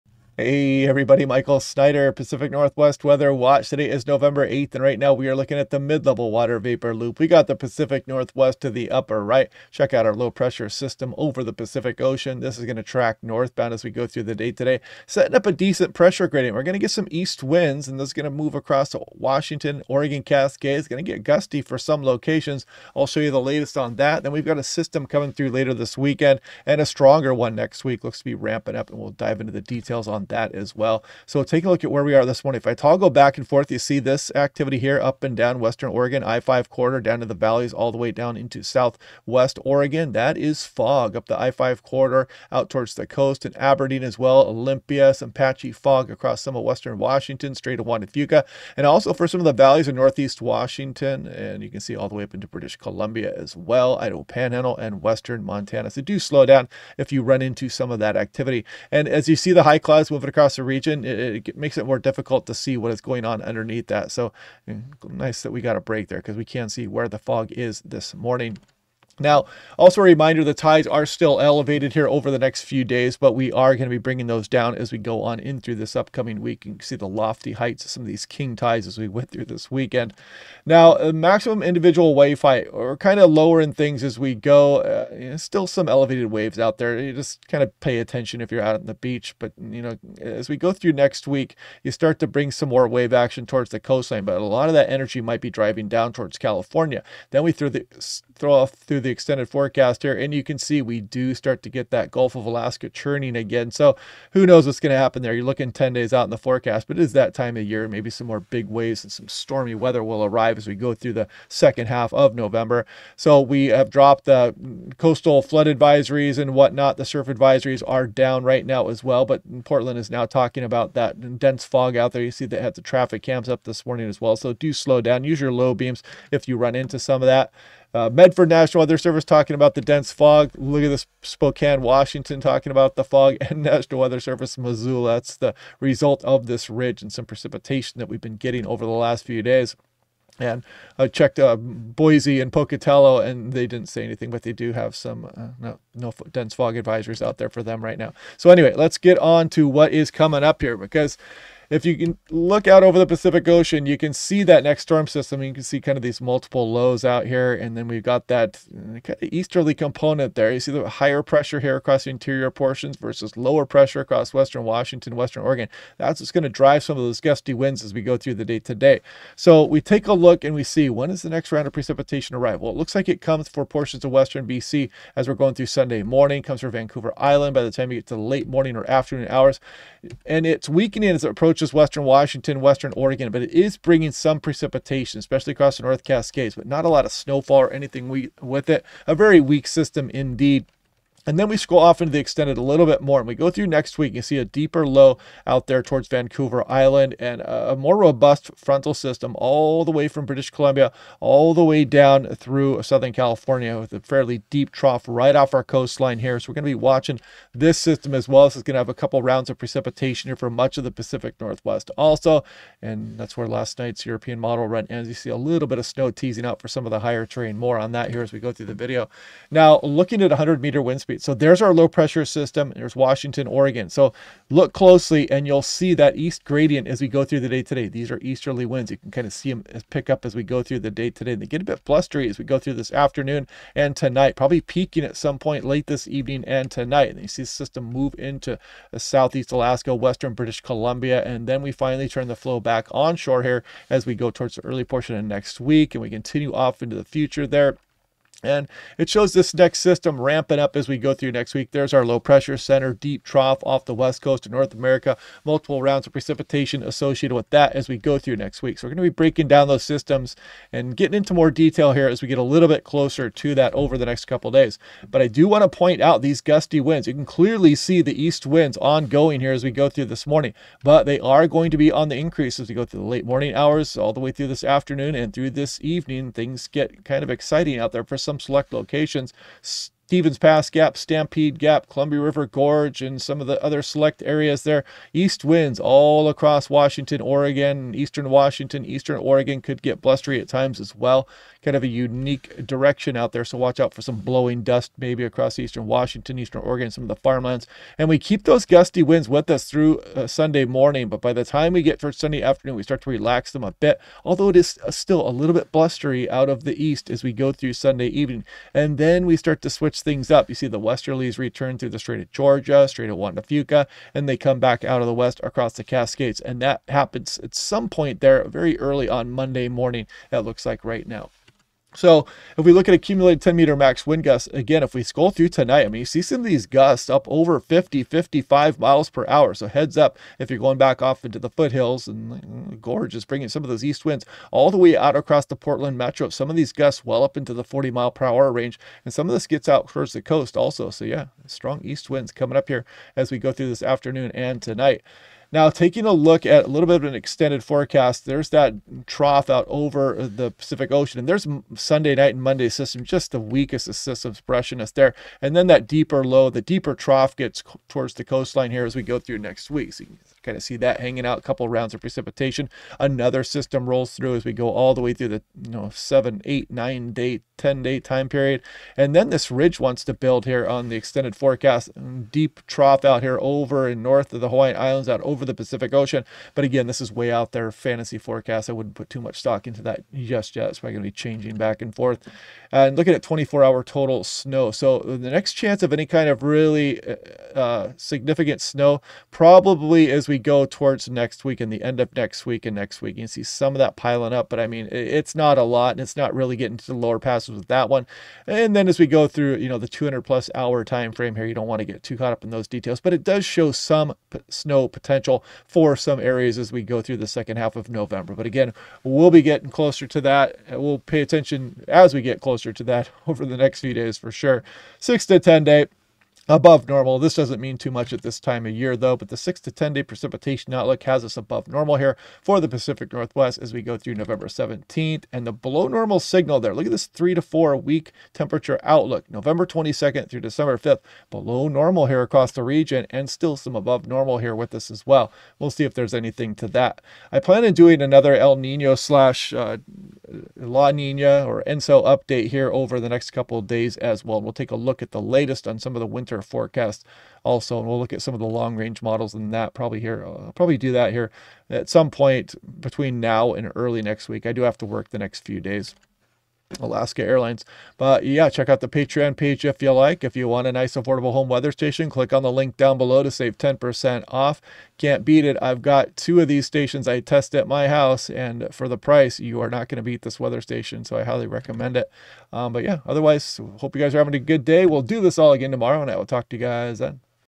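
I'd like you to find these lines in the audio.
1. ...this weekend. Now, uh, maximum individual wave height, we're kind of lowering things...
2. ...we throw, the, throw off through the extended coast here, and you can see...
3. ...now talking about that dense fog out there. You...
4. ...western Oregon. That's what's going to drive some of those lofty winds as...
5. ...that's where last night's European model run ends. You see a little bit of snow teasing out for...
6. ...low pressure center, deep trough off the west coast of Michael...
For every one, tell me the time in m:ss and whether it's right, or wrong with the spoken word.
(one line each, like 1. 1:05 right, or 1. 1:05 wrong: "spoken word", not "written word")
1. 1:19 right
2. 1:37 wrong: "forecast", not "coast"
3. 2:00 right
4. 2:45 wrong: "gusty", not "lofty"
5. 3:33 right
6. 4:12 wrong: "North", not "Michael".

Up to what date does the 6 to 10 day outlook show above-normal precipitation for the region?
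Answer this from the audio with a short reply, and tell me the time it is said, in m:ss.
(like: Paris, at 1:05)
November 17th, at 7:04.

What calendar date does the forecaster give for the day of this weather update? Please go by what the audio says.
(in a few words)
November 8th.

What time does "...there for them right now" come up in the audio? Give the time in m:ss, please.
2:27.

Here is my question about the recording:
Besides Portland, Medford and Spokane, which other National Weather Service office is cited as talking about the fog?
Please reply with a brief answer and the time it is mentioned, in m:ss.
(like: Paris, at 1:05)
Missoula, at 2:13.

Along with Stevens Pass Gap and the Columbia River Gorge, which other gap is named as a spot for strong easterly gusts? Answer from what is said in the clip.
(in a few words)
Stampede Gap.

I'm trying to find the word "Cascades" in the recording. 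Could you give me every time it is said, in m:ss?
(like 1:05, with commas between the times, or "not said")
0:20, 3:06, 5:15.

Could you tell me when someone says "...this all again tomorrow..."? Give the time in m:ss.
7:55.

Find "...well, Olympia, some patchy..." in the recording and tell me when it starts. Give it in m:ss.
0:44.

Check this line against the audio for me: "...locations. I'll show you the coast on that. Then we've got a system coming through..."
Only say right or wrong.
wrong.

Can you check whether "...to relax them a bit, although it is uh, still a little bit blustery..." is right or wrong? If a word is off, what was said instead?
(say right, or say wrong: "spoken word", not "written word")
right.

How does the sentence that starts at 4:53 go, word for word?
So watch out for some blowing dust maybe across eastern Washington, eastern Oregon, some of the farmlands.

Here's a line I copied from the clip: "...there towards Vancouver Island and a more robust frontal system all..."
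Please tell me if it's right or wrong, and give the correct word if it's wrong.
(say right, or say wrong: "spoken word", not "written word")
right.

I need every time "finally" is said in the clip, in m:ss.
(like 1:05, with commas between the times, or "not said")
4:01.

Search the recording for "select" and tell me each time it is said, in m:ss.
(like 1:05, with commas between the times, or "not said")
4:38, 4:43.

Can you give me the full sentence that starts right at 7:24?
We'll take a look at the latest on some of the winter our forecast also.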